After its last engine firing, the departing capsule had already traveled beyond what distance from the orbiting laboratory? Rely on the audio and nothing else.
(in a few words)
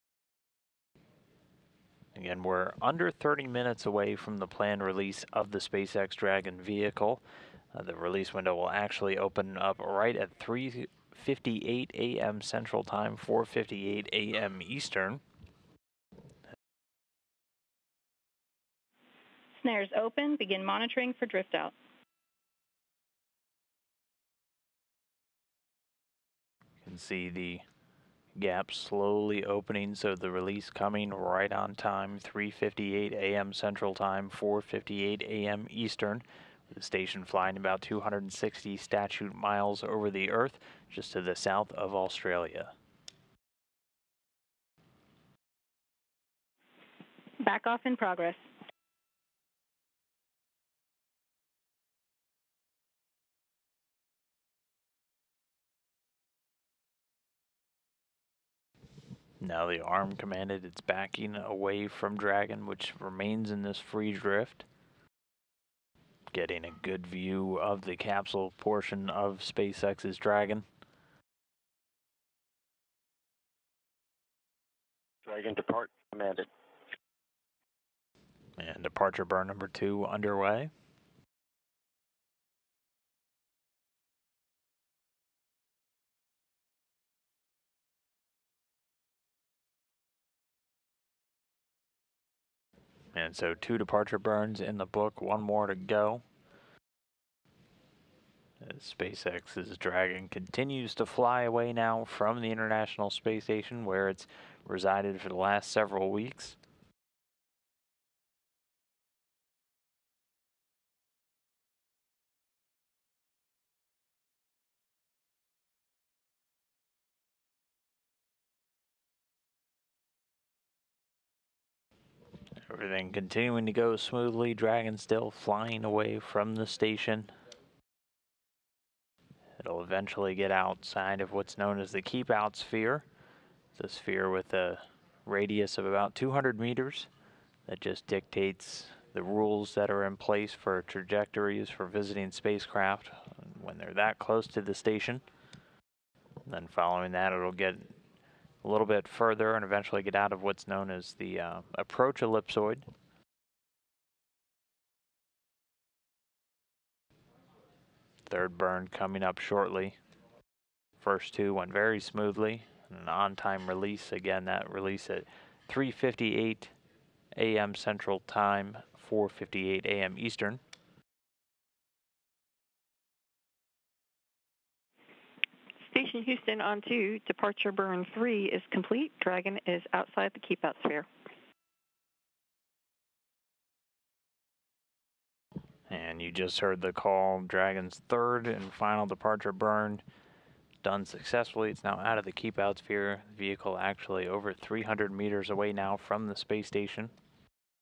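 300 meters.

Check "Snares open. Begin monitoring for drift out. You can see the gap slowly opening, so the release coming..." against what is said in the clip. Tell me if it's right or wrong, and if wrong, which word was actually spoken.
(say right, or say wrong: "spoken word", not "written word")
right.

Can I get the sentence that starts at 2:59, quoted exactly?
Dragon is outside the keep out sphere.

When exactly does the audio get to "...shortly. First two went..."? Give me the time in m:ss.
2:39.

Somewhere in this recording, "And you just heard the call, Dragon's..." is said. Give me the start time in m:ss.
3:05.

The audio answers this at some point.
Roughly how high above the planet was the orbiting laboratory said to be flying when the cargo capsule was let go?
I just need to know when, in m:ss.
0:37.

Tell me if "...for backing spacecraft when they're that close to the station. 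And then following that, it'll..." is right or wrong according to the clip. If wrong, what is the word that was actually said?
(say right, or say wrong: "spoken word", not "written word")
wrong: "visiting", not "backing".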